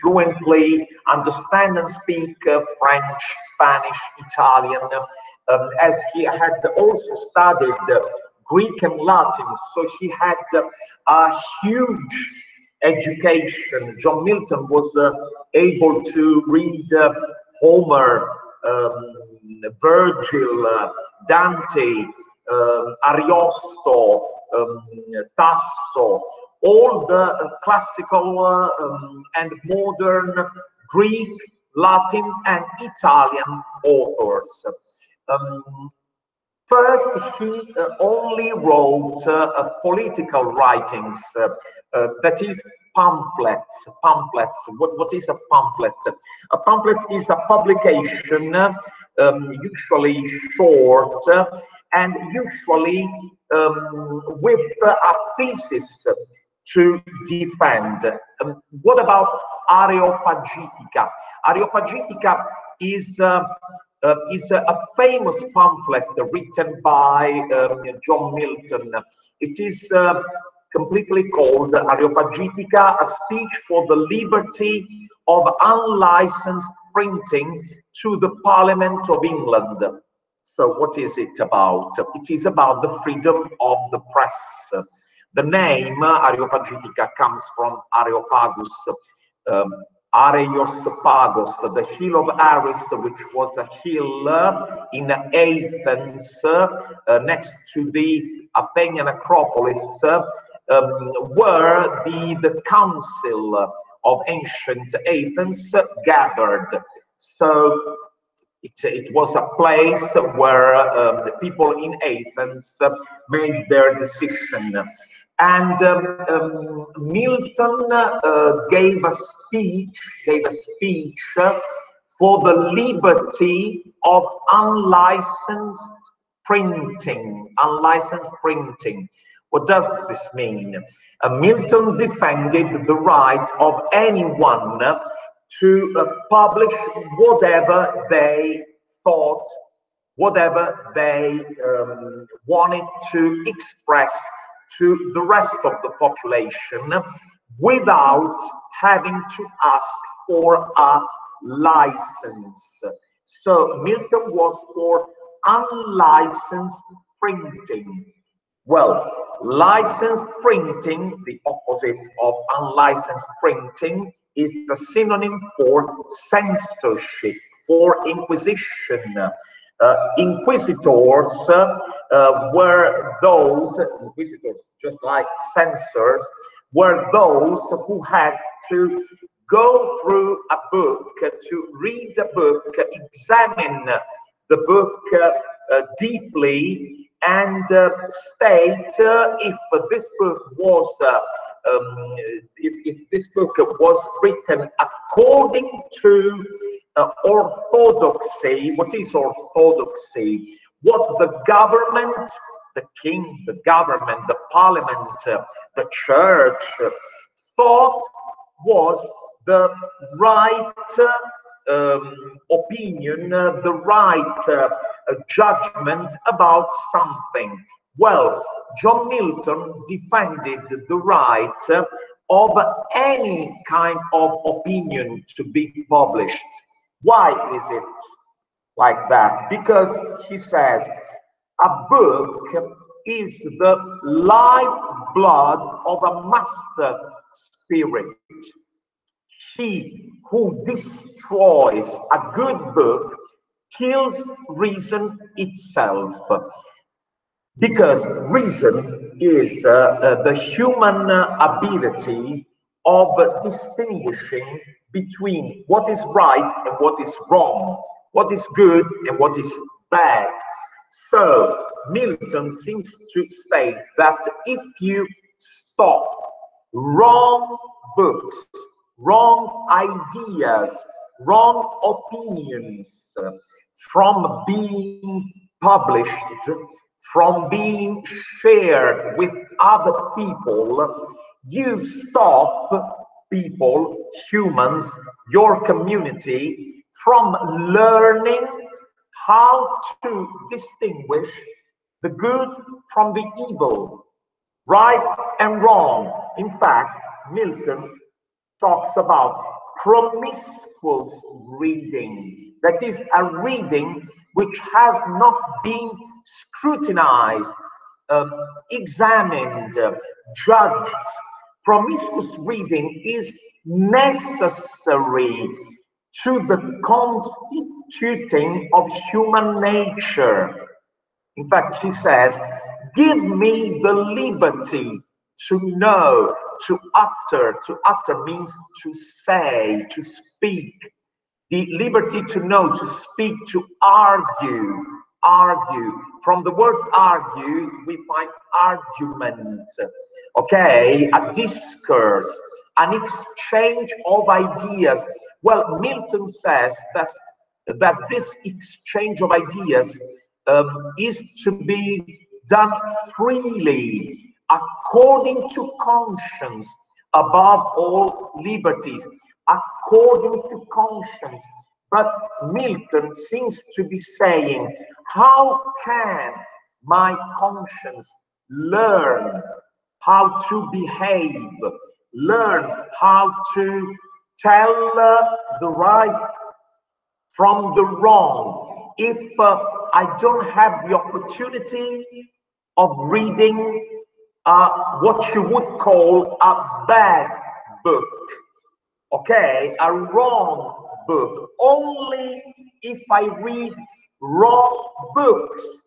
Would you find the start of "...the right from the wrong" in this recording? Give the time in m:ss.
6:15.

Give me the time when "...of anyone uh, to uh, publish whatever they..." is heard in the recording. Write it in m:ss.
2:13.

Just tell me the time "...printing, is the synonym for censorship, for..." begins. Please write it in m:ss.
2:43.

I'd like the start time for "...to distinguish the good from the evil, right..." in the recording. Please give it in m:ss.
4:50.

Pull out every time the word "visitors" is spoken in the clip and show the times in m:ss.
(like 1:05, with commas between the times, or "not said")
2:54.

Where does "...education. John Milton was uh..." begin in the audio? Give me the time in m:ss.
0:12.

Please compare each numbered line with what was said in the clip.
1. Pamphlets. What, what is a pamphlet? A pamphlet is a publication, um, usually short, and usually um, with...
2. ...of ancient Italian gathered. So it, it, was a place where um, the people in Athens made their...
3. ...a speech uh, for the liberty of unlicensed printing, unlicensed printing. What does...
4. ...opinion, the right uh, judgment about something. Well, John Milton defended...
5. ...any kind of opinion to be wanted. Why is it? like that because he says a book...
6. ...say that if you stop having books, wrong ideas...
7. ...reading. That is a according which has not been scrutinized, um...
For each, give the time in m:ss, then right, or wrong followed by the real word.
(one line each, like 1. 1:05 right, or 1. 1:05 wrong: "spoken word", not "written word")
1. 0:44 right
2. 1:44 wrong: "Athens", not "Italian"
3. 2:00 right
4. 3:32 right
5. 3:42 wrong: "published", not "wanted"
6. 4:23 wrong: "wrong", not "having"
7. 5:01 wrong: "reading", not "according".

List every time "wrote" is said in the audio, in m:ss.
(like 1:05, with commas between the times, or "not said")
0:38.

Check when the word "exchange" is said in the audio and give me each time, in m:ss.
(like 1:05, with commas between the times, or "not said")
5:42, 5:48.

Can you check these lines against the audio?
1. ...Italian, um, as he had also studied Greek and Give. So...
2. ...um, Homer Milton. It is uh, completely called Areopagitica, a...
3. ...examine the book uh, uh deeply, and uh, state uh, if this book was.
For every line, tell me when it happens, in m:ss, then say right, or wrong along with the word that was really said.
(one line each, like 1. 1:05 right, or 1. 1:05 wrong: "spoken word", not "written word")
1. 0:04 wrong: "Latin", not "Give"
2. 1:07 wrong: "John", not "Homer"
3. 3:02 right.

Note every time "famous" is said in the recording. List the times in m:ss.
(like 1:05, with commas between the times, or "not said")
1:04.